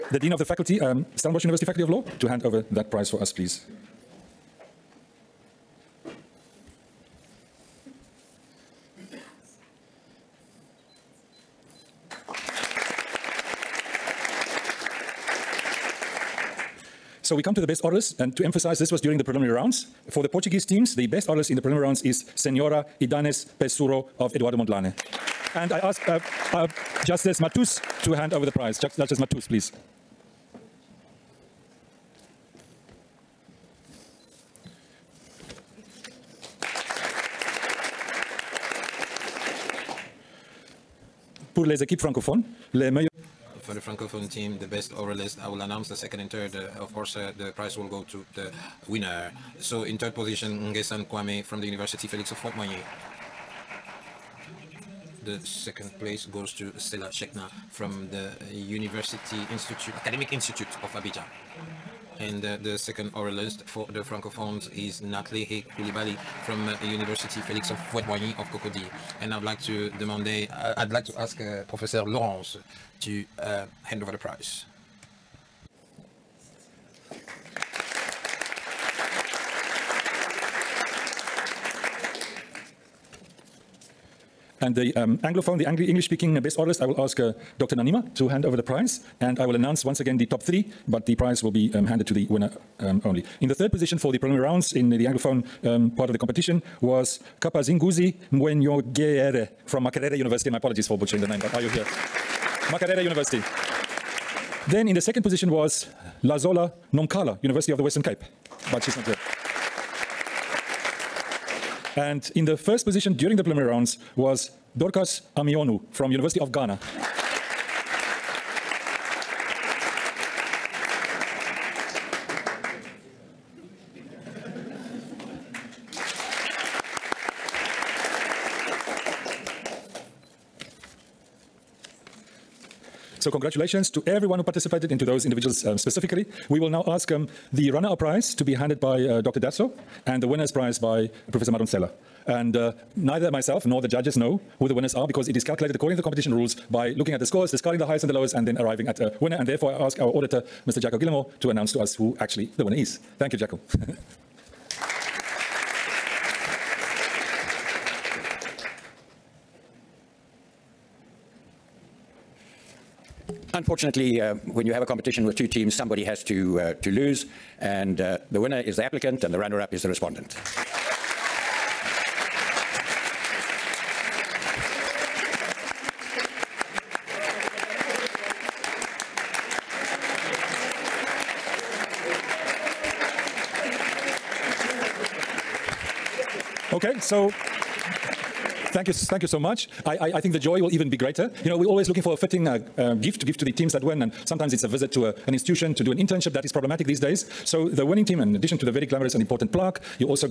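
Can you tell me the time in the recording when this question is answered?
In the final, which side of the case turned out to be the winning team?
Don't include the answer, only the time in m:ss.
2:48.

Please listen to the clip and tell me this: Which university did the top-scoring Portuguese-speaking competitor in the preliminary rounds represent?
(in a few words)
Eduardo Mondlane.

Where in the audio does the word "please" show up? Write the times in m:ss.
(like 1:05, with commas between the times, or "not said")
0:03, 0:29.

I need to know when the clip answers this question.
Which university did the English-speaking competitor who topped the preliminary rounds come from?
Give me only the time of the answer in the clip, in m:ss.
1:56.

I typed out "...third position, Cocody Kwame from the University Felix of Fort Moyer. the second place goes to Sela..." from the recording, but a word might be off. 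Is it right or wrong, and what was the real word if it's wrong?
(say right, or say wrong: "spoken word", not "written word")
wrong: "Ngesan", not "Cocody".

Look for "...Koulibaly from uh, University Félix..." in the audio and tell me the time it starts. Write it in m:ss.
1:05.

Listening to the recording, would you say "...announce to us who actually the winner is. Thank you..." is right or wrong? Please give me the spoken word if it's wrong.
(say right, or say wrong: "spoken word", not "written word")
right.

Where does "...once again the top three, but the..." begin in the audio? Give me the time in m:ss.
1:29.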